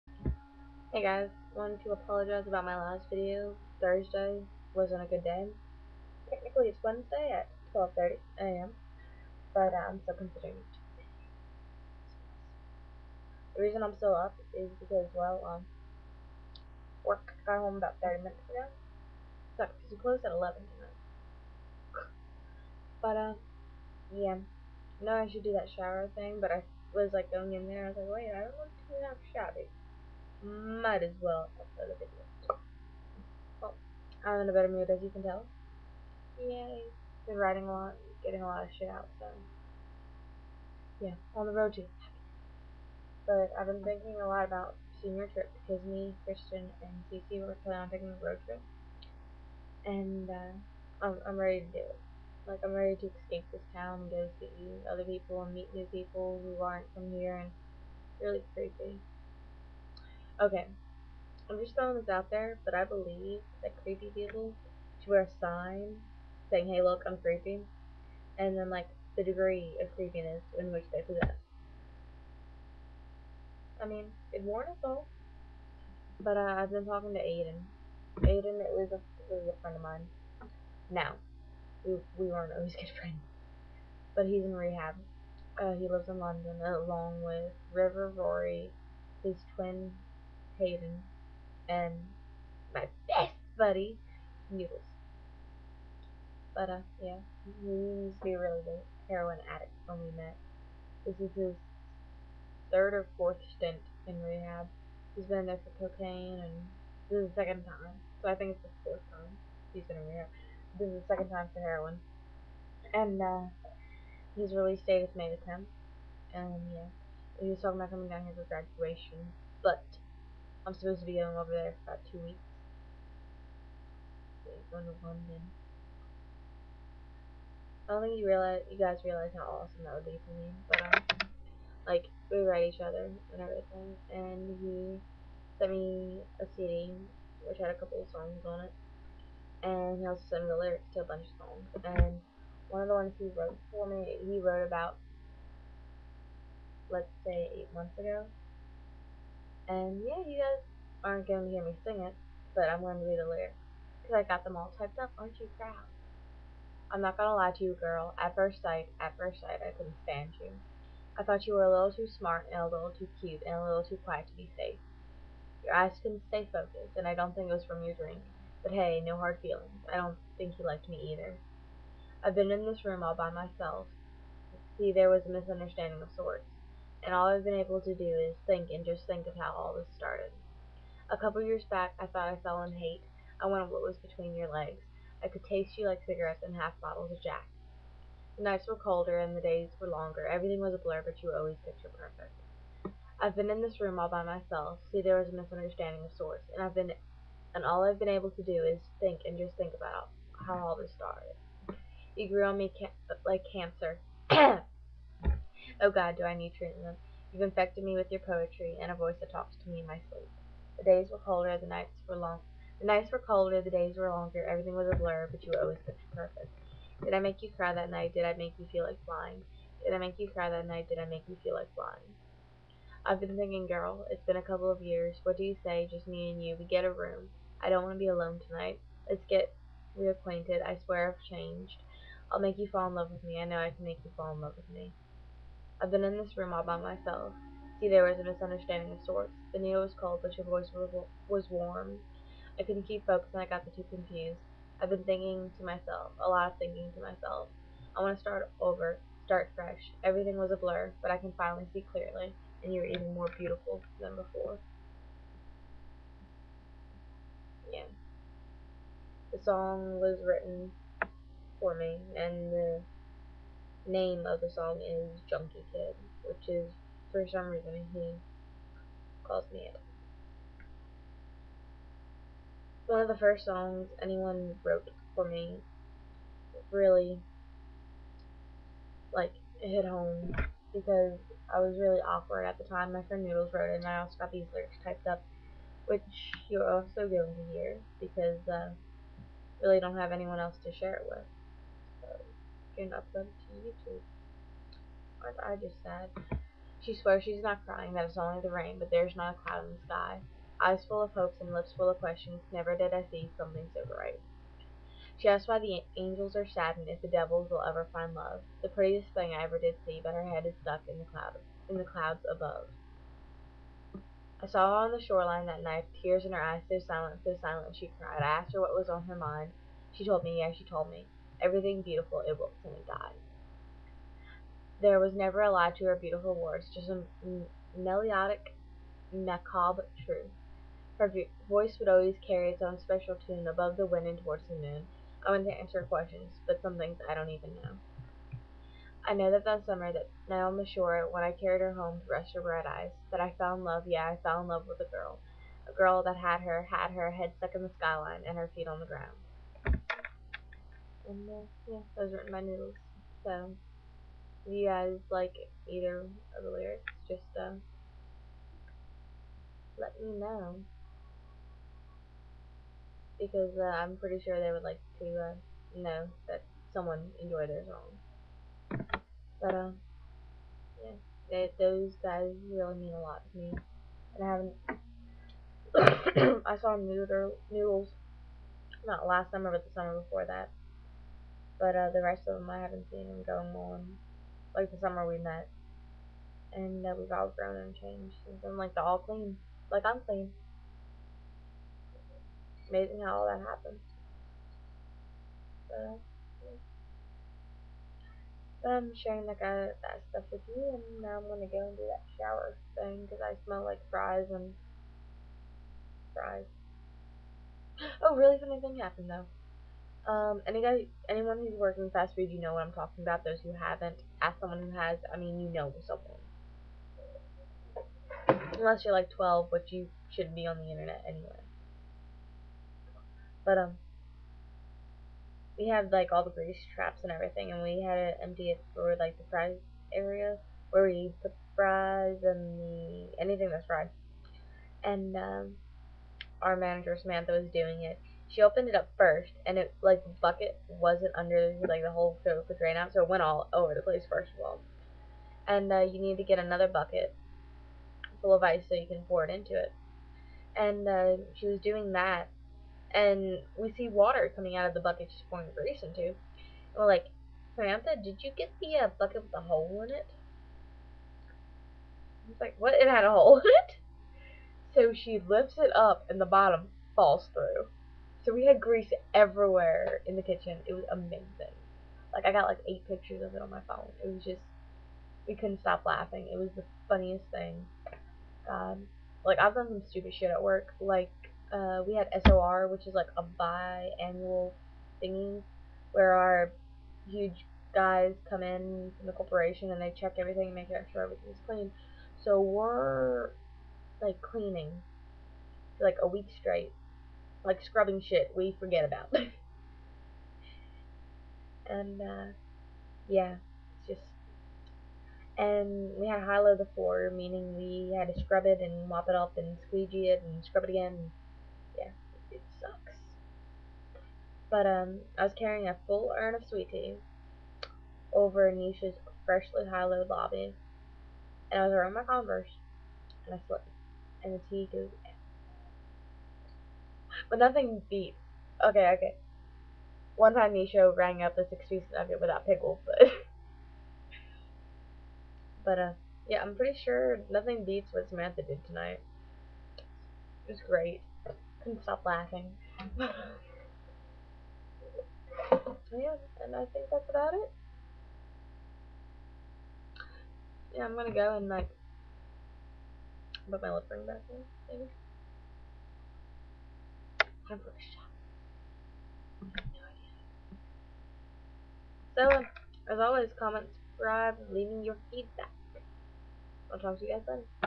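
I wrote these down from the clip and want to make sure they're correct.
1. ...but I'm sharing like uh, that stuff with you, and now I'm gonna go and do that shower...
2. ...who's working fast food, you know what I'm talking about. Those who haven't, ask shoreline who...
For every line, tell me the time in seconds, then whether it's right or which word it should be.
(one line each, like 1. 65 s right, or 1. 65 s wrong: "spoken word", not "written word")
1. 398 s right
2. 411 s wrong: "someone", not "shoreline".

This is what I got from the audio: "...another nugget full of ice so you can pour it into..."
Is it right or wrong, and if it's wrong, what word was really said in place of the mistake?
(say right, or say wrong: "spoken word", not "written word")
wrong: "bucket", not "nugget".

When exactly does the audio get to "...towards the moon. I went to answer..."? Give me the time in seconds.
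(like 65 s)
334 s.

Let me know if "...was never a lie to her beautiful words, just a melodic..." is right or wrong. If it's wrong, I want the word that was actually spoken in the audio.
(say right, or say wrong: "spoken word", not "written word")
right.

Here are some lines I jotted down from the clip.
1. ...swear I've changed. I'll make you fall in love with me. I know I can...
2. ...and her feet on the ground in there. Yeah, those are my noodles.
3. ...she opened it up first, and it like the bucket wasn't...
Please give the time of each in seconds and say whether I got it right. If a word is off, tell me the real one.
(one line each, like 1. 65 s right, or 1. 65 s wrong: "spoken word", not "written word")
1. 230 s right
2. 348 s right
3. 438 s right.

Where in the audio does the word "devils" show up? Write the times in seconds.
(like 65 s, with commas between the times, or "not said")
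307 s.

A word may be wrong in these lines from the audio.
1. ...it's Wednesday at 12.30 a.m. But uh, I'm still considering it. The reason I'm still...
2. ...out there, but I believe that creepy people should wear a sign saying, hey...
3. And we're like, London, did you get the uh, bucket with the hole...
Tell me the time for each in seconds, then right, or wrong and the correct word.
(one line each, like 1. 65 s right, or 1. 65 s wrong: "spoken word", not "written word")
1. 6 s right
2. 62 s right
3. 456 s wrong: "Samantha", not "London".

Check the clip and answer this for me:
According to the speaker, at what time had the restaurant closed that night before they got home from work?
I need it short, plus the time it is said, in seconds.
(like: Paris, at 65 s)
11, at 20 s.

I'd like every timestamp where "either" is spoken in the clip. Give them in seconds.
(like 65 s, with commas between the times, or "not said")
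171 s, 355 s.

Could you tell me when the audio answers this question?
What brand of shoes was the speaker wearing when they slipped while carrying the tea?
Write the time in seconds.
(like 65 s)
522 s.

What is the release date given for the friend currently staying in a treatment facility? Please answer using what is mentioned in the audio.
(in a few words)
May 10th.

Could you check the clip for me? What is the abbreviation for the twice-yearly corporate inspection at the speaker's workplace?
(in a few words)
SOR.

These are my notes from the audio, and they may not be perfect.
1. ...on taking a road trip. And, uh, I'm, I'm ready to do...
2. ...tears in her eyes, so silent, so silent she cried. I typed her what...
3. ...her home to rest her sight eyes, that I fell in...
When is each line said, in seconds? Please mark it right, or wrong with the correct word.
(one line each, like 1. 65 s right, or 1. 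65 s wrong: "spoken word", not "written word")
1. 47 s right
2. 316 s wrong: "asked", not "typed"
3. 341 s wrong: "bright", not "sight".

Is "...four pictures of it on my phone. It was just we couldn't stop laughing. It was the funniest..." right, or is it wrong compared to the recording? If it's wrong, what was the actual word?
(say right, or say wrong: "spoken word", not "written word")
wrong: "eight", not "four".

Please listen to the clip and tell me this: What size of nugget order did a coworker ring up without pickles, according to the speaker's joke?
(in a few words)
six piece.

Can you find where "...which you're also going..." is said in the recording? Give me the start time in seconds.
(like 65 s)
285 s.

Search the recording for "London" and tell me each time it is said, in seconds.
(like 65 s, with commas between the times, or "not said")
86 s, 125 s.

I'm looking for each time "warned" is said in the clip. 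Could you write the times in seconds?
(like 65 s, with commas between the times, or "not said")
74 s.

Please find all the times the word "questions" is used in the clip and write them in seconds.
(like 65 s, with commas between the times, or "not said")
301 s, 335 s.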